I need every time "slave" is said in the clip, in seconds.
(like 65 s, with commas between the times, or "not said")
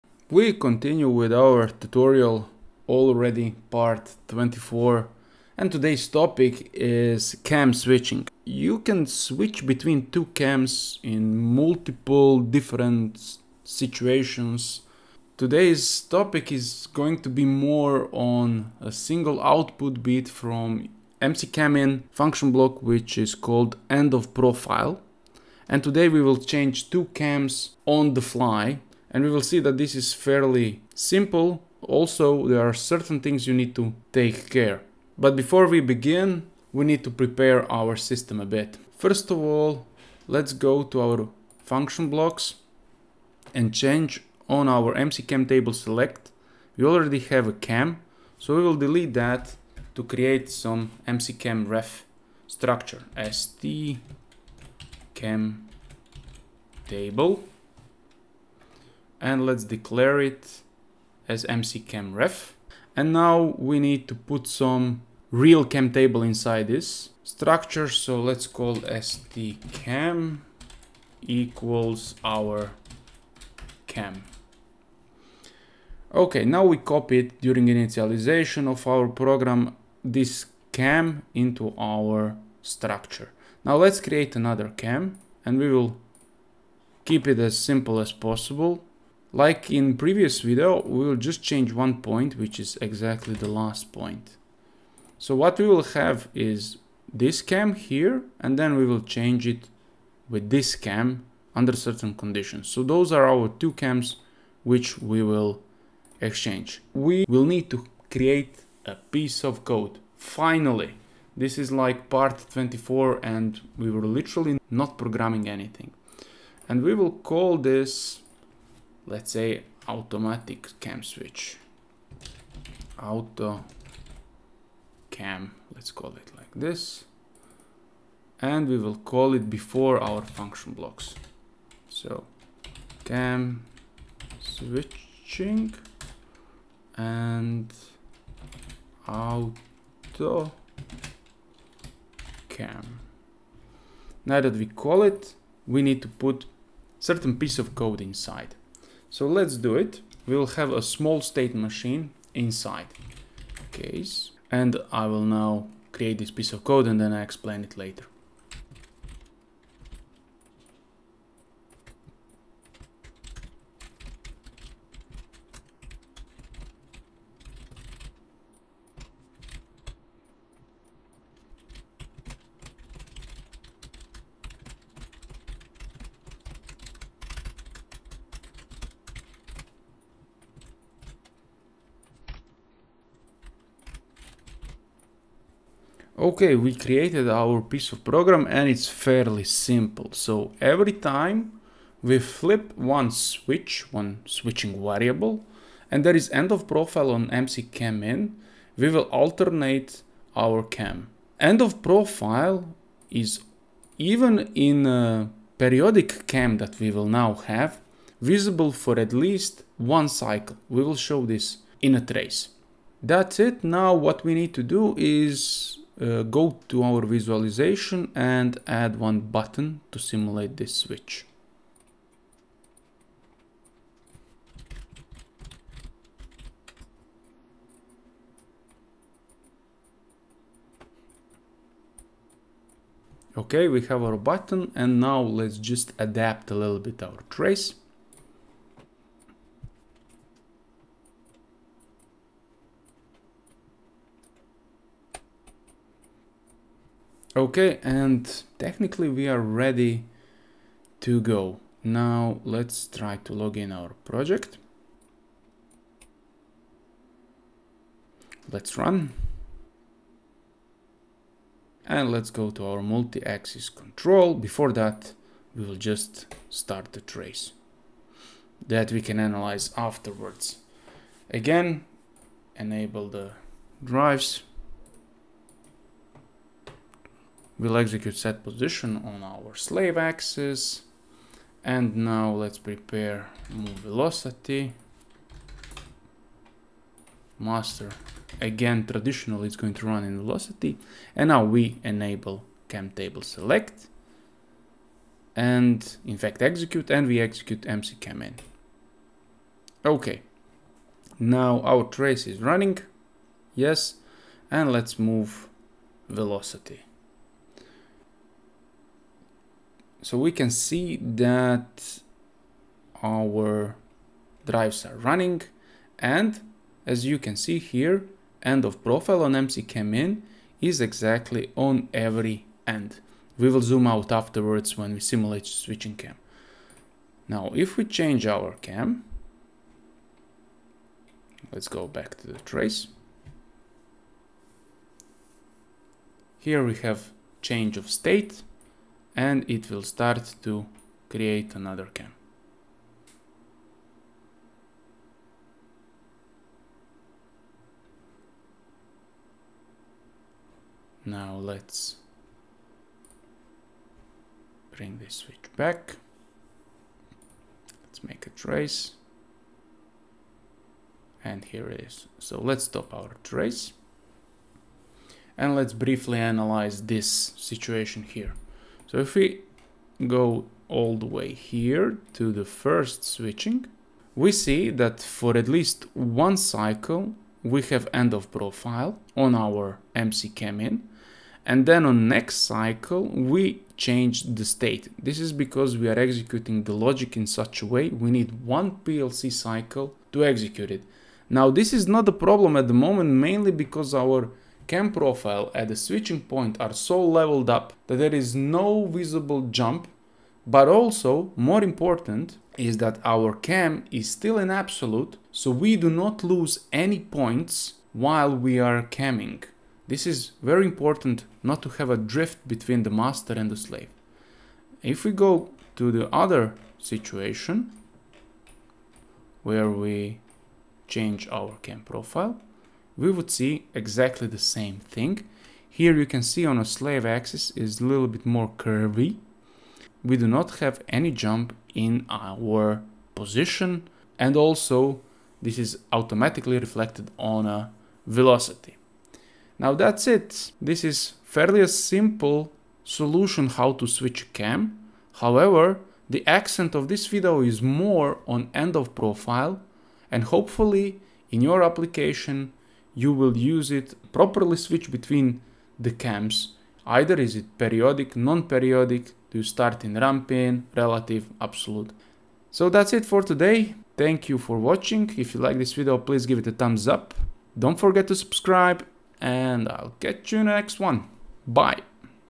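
279 s, 413 s, 426 s.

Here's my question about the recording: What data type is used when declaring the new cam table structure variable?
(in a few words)
mccamref.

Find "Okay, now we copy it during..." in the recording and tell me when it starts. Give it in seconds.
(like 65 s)
76 s.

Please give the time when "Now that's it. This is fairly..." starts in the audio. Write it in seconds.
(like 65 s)
439 s.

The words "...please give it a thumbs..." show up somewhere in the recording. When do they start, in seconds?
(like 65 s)
465 s.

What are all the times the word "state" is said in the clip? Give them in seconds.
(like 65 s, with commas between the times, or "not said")
151 s, 337 s, 384 s.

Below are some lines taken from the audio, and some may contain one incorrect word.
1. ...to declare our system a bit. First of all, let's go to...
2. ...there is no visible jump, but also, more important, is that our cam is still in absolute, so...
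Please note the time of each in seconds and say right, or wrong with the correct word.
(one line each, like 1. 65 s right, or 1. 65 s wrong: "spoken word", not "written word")
1. 37 s wrong: "prepare", not "declare"
2. 397 s right.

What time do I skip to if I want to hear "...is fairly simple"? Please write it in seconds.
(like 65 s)
29 s.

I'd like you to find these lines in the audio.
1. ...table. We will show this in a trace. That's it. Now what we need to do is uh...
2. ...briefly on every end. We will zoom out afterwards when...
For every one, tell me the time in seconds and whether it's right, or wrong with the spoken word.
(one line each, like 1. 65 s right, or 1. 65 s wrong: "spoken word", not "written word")
1. 210 s wrong: "cycle", not "table"
2. 320 s wrong: "exactly", not "briefly".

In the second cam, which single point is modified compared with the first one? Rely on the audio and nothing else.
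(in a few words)
the last point.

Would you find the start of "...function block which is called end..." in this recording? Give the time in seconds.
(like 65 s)
22 s.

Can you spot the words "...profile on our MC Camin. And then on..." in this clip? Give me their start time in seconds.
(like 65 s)
378 s.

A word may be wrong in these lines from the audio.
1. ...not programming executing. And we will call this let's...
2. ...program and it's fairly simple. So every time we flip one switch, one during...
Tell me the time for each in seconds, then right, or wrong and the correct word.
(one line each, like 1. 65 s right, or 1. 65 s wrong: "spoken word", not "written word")
1. 114 s wrong: "anything", not "executing"
2. 188 s wrong: "switching", not "during".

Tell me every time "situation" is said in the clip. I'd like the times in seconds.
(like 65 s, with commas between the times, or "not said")
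13 s, 367 s, 416 s.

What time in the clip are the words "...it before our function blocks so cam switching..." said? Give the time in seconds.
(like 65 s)
129 s.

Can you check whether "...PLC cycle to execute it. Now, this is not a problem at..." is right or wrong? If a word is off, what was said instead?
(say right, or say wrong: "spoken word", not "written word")
right.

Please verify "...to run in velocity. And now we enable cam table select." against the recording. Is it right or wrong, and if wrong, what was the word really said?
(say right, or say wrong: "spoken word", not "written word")
right.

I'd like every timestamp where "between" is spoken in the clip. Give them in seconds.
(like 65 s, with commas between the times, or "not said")
9 s, 412 s, 454 s.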